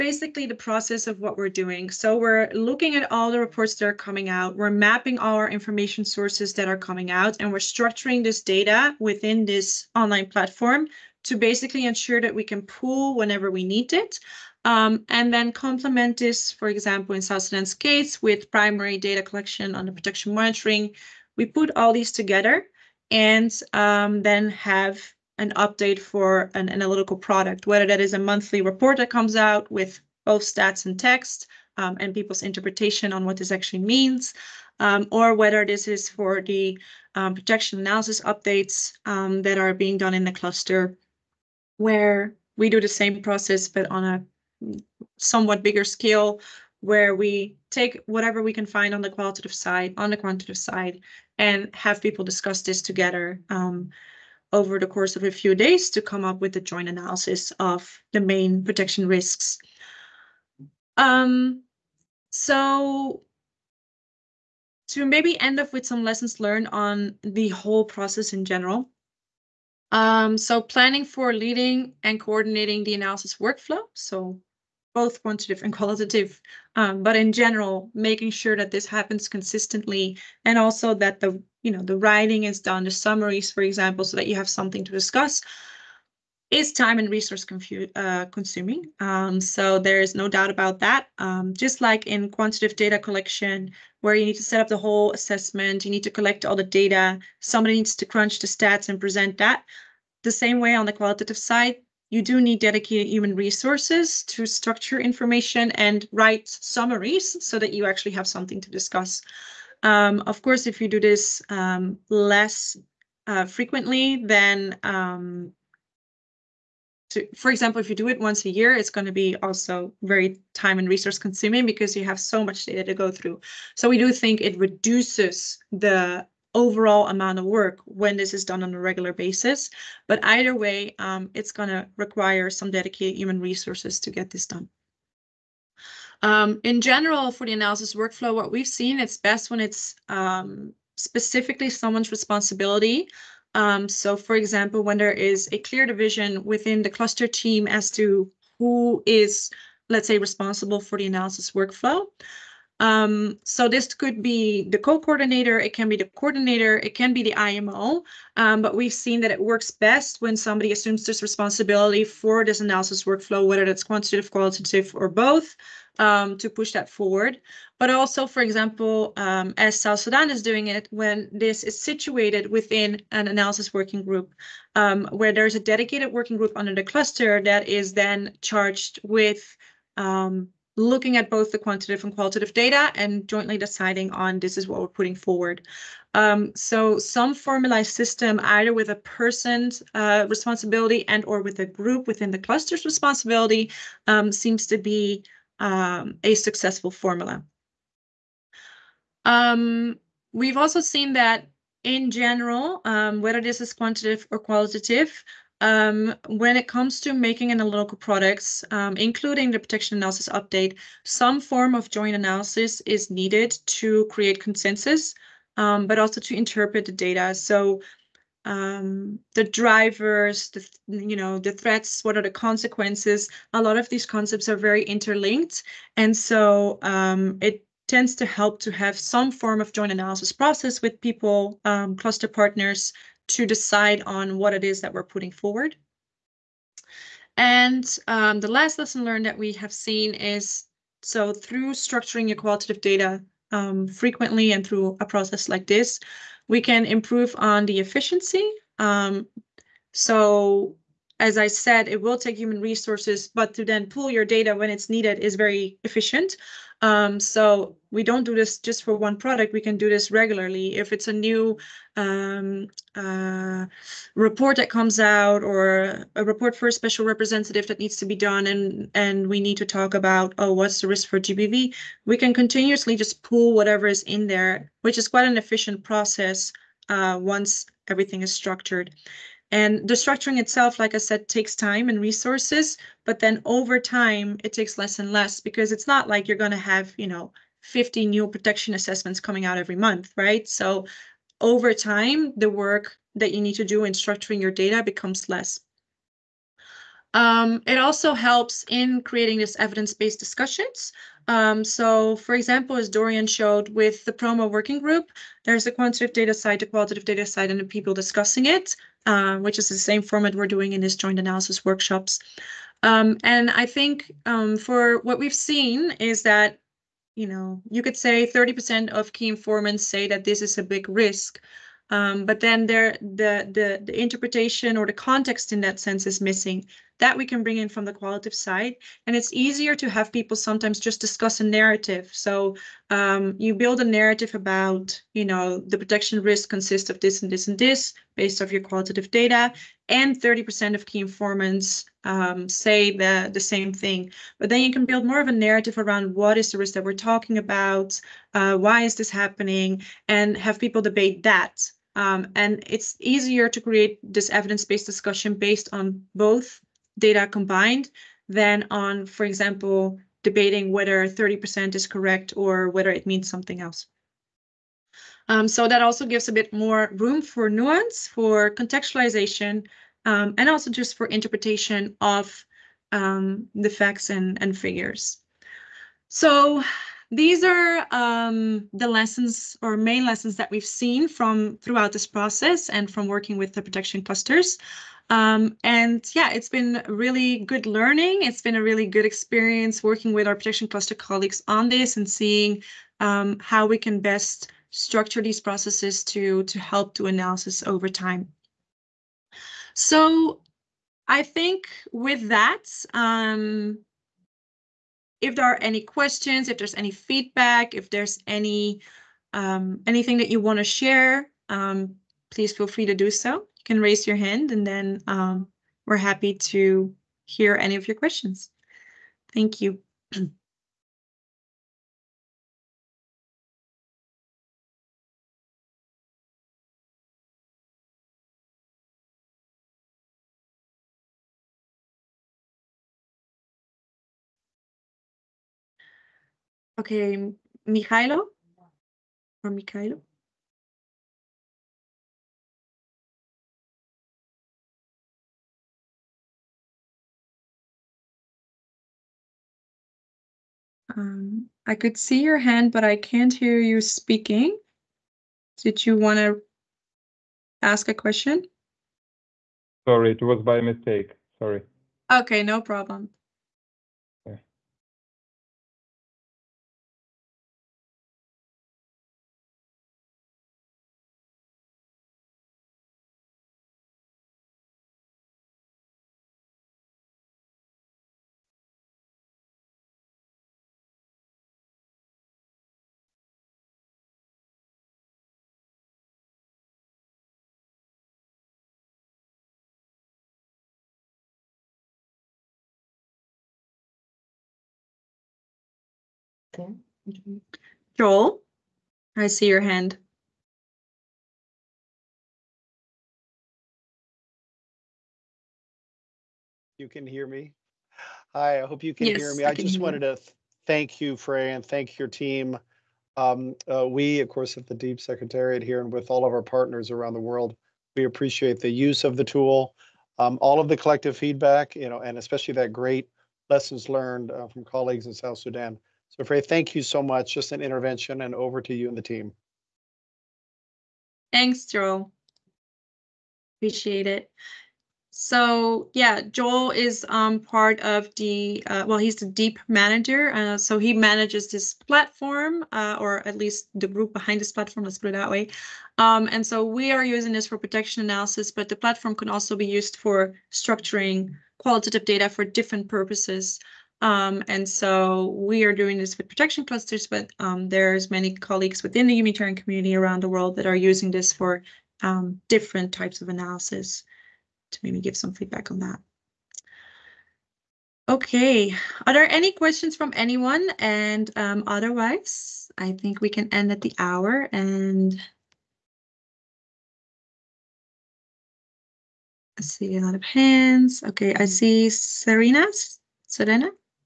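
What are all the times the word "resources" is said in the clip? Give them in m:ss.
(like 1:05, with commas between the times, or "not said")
1:27, 1:43, 2:00, 2:13, 4:12, 4:41.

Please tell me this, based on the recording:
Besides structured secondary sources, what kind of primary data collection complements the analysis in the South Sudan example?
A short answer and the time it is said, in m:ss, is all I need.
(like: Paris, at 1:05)
Protection monitoring, at 0:19.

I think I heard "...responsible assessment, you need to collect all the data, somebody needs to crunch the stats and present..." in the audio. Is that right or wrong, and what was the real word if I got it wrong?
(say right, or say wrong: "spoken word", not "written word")
wrong: "whole", not "responsible".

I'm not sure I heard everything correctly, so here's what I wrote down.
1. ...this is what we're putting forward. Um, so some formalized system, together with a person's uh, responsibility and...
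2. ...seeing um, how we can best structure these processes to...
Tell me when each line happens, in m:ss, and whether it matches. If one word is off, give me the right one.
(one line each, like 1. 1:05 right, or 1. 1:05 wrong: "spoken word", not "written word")
1. 3:04 wrong: "either", not "together"
2. 6:32 right.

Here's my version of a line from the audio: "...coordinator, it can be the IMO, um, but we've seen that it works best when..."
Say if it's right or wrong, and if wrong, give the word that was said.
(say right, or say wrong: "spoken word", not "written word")
right.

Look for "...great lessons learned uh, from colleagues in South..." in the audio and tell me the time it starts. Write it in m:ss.
8:42.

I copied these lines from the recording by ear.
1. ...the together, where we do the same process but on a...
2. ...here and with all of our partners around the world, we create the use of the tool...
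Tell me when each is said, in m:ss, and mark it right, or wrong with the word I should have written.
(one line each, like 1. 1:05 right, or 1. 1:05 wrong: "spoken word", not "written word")
1. 0:40 wrong: "cluster", not "together"
2. 8:35 wrong: "appreciate", not "create".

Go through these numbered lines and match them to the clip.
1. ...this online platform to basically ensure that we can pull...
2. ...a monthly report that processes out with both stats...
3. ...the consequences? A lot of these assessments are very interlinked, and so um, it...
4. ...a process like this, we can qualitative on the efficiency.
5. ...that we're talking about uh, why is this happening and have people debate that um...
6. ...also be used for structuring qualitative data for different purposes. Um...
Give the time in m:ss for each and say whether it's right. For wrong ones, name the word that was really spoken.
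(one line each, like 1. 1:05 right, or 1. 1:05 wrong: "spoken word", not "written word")
1. 0:09 right
2. 0:28 wrong: "comes", not "processes"
3. 3:42 wrong: "concepts", not "assessments"
4. 4:04 wrong: "improve", not "qualitative"
5. 5:46 right
6. 9:09 right.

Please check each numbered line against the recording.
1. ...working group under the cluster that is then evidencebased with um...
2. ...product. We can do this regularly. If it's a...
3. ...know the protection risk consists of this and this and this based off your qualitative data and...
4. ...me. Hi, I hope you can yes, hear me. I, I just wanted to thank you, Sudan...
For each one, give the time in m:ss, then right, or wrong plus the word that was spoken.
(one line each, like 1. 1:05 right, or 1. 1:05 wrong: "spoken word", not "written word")
1. 2:56 wrong: "charged", not "evidencebased"
2. 4:19 right
3. 5:35 right
4. 8:27 wrong: "Frey", not "Sudan".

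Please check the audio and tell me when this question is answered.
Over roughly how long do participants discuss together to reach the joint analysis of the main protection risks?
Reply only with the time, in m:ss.
0:55.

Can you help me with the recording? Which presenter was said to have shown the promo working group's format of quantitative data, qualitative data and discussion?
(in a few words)
Dorian.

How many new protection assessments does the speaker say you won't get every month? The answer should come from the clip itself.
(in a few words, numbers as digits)
50.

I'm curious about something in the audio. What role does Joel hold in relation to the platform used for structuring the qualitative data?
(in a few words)
DEEP manager.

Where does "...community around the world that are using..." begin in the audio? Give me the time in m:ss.
9:19.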